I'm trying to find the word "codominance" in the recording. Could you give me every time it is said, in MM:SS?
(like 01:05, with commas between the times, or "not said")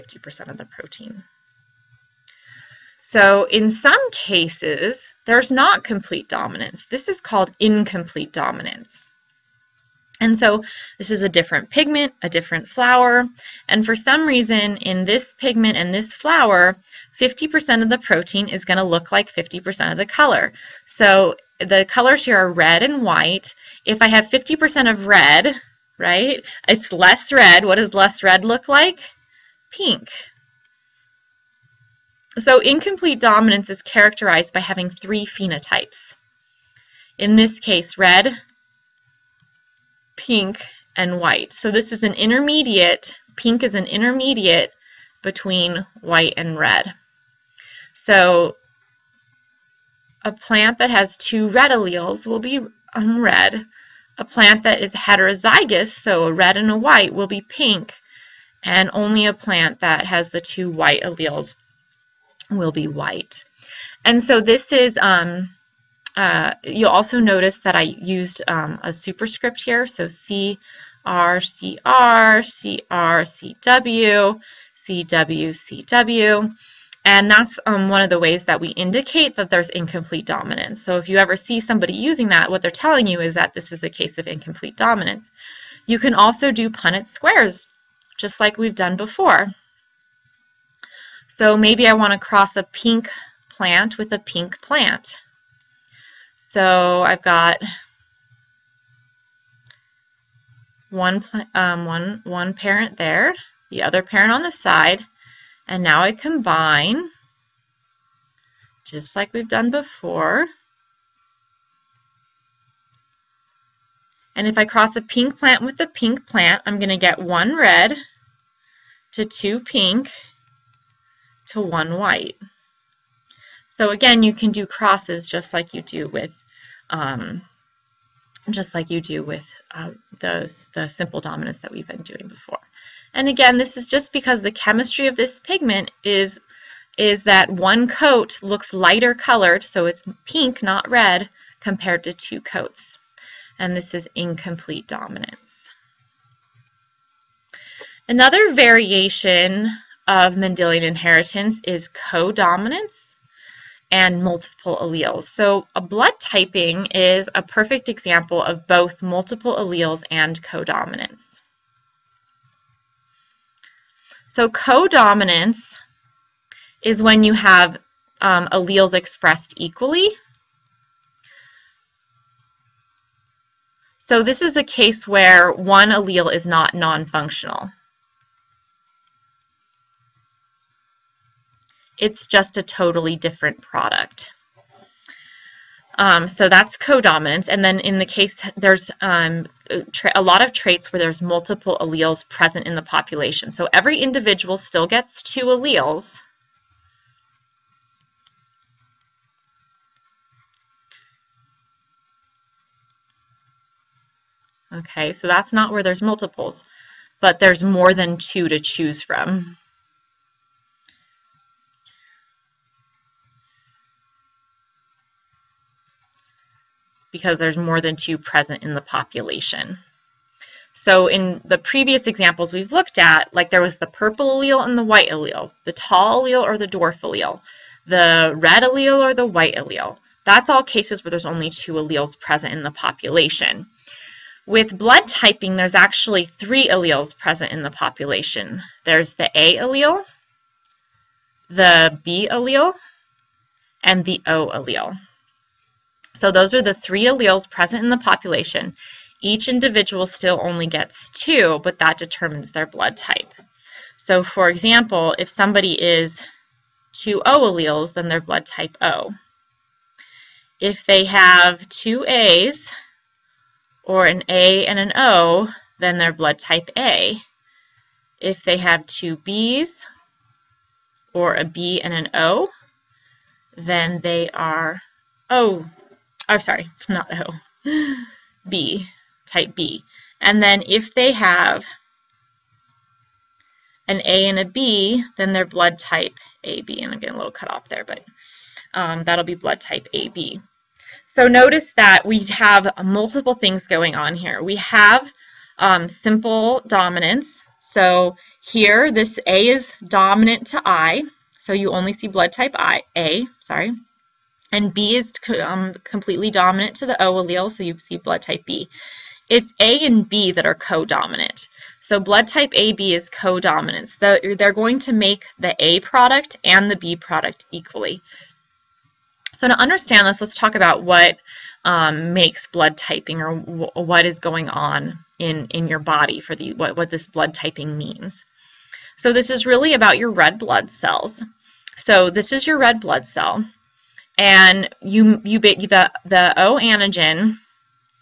02:31, 02:40, 02:44, 03:06.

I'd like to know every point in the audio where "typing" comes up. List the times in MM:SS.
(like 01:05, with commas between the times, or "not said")
02:36, 03:55, 05:22, 05:27.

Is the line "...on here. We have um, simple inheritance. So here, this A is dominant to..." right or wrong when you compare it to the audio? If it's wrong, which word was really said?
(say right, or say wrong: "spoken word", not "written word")
wrong: "dominance", not "inheritance".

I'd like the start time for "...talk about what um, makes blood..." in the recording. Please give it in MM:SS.
05:20.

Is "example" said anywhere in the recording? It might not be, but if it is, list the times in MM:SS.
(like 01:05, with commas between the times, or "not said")
02:37, 03:42, 04:14.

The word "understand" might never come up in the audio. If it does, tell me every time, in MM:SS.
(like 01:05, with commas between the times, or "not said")
05:19.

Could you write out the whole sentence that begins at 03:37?
because there's more than two present in the population.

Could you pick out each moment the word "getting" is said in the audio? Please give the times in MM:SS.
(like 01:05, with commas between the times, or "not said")
04:46.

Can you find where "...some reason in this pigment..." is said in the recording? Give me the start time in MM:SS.
00:13.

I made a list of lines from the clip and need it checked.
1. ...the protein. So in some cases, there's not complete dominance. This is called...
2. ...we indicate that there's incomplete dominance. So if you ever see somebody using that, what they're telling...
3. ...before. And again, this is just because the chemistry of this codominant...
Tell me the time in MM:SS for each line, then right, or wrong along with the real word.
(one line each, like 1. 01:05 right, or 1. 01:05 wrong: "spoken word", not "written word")
1. 00:00 right
2. 01:18 right
3. 02:12 wrong: "pigment", not "codominant".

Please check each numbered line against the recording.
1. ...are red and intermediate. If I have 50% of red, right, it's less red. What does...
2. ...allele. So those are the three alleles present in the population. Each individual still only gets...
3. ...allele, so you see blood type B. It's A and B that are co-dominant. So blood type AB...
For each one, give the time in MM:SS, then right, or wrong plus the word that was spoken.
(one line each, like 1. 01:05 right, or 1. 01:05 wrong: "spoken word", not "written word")
1. 00:22 wrong: "white", not "intermediate"
2. 04:04 right
3. 05:07 right.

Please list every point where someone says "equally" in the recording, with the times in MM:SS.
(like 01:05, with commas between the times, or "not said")
02:49, 05:17.